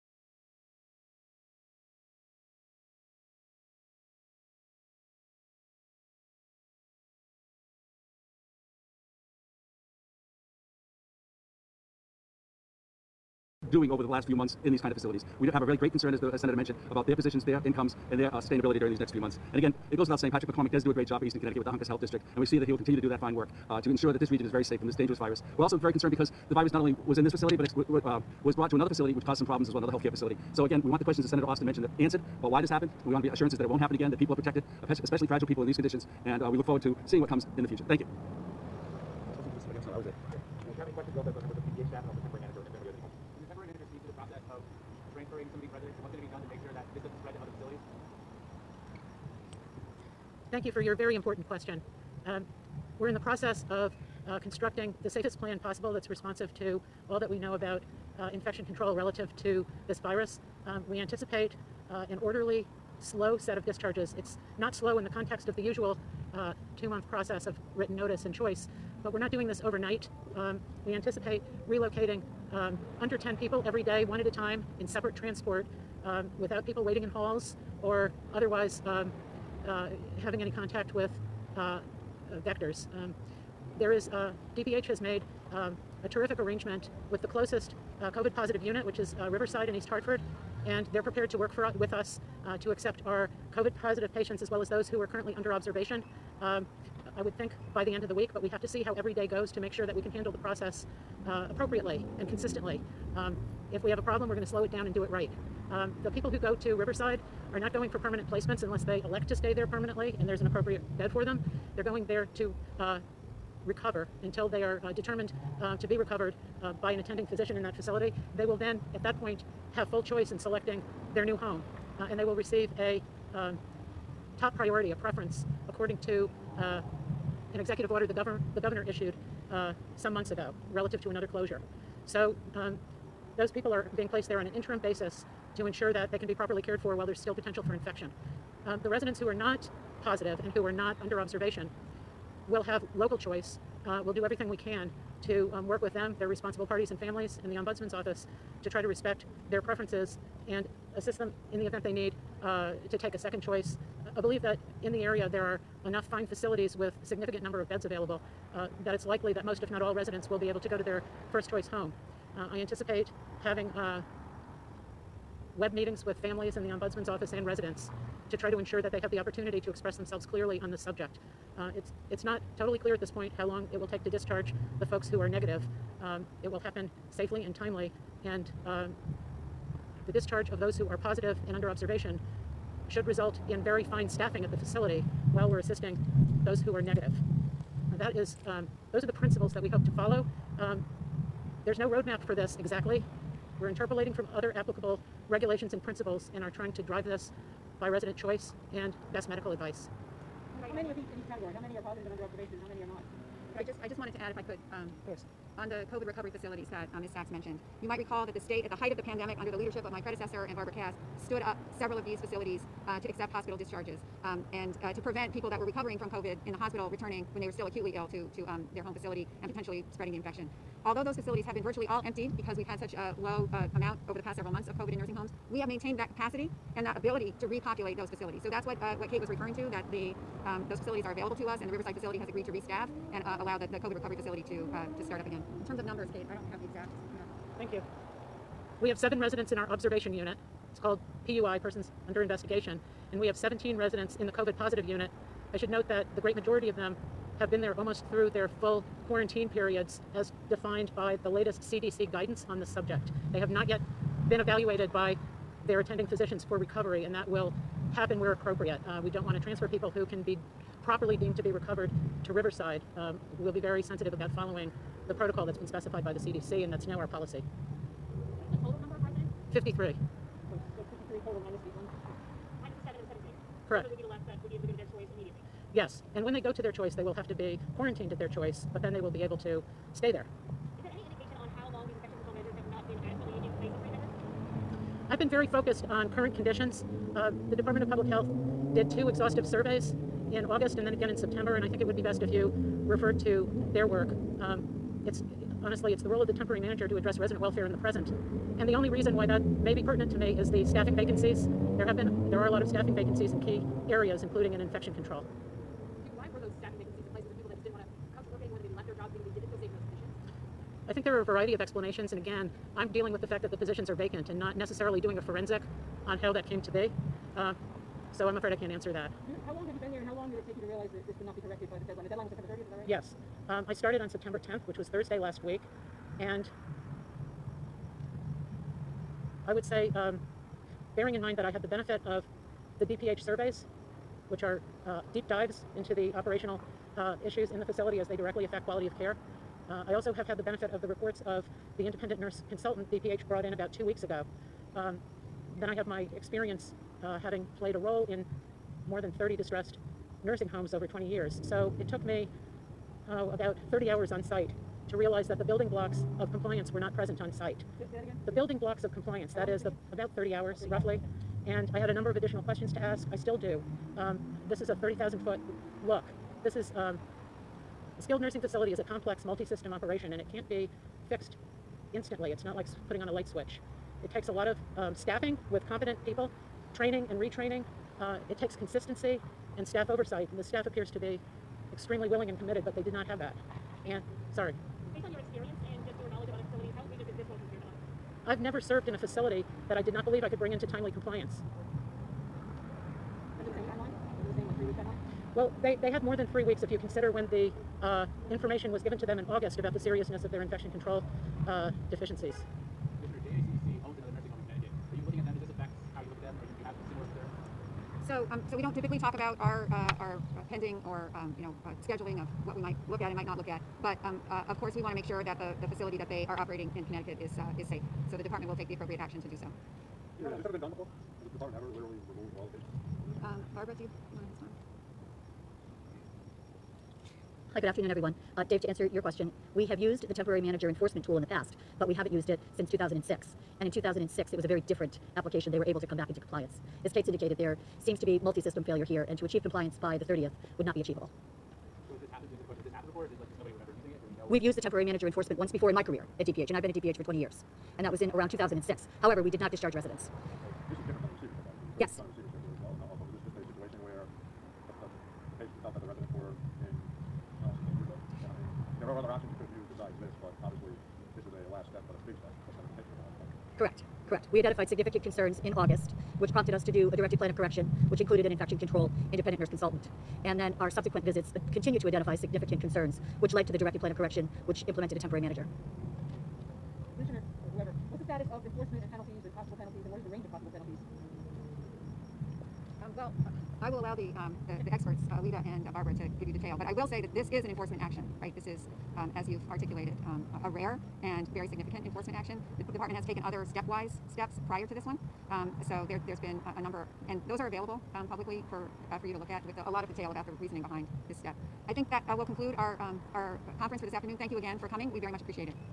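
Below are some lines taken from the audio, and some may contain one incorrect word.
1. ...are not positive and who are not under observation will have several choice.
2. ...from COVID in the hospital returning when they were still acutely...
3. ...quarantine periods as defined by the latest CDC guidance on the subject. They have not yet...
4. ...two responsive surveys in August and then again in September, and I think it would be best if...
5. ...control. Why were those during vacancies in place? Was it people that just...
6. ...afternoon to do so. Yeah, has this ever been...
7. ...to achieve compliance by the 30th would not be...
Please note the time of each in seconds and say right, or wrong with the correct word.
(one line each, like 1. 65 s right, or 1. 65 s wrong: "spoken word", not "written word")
1. 139 s wrong: "local", not "several"
2. 215 s right
3. 249 s right
4. 288 s wrong: "exhaustive", not "responsive"
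5. 304 s wrong: "staffing", not "during"
6. 418 s wrong: "action", not "afternoon"
7. 439 s right.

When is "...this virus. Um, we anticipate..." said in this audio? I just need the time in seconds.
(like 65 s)
59 s.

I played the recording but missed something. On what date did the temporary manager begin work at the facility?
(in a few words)
September 10th.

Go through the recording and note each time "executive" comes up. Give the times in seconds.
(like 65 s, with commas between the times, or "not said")
127 s.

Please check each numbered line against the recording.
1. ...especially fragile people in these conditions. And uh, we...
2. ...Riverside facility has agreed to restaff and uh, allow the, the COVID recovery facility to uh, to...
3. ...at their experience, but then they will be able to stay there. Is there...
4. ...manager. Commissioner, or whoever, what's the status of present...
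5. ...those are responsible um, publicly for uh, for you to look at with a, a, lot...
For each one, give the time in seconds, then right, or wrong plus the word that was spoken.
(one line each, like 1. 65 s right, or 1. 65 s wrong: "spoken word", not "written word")
1. 35 s right
2. 231 s right
3. 278 s wrong: "choice", not "experience"
4. 475 s wrong: "enforcement", not "present"
5. 497 s wrong: "available", not "responsible".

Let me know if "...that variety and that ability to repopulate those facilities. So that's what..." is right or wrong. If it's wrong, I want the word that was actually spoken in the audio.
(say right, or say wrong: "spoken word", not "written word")
wrong: "capacity", not "variety".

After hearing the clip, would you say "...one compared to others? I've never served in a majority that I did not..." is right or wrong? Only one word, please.
wrong.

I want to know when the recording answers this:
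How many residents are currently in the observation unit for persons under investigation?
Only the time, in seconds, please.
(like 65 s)
238 s.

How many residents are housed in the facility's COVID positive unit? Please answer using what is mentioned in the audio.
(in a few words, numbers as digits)
17.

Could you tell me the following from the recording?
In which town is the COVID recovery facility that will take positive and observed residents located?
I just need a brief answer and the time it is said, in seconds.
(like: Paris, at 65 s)
East Hartford, at 89 s.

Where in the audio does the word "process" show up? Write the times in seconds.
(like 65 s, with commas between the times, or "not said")
44 s, 53 s, 67 s, 100 s.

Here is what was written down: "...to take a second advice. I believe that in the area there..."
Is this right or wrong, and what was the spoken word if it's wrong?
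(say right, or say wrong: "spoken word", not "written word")
wrong: "choice", not "advice".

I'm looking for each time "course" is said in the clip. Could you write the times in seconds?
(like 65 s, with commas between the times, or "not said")
205 s, 414 s.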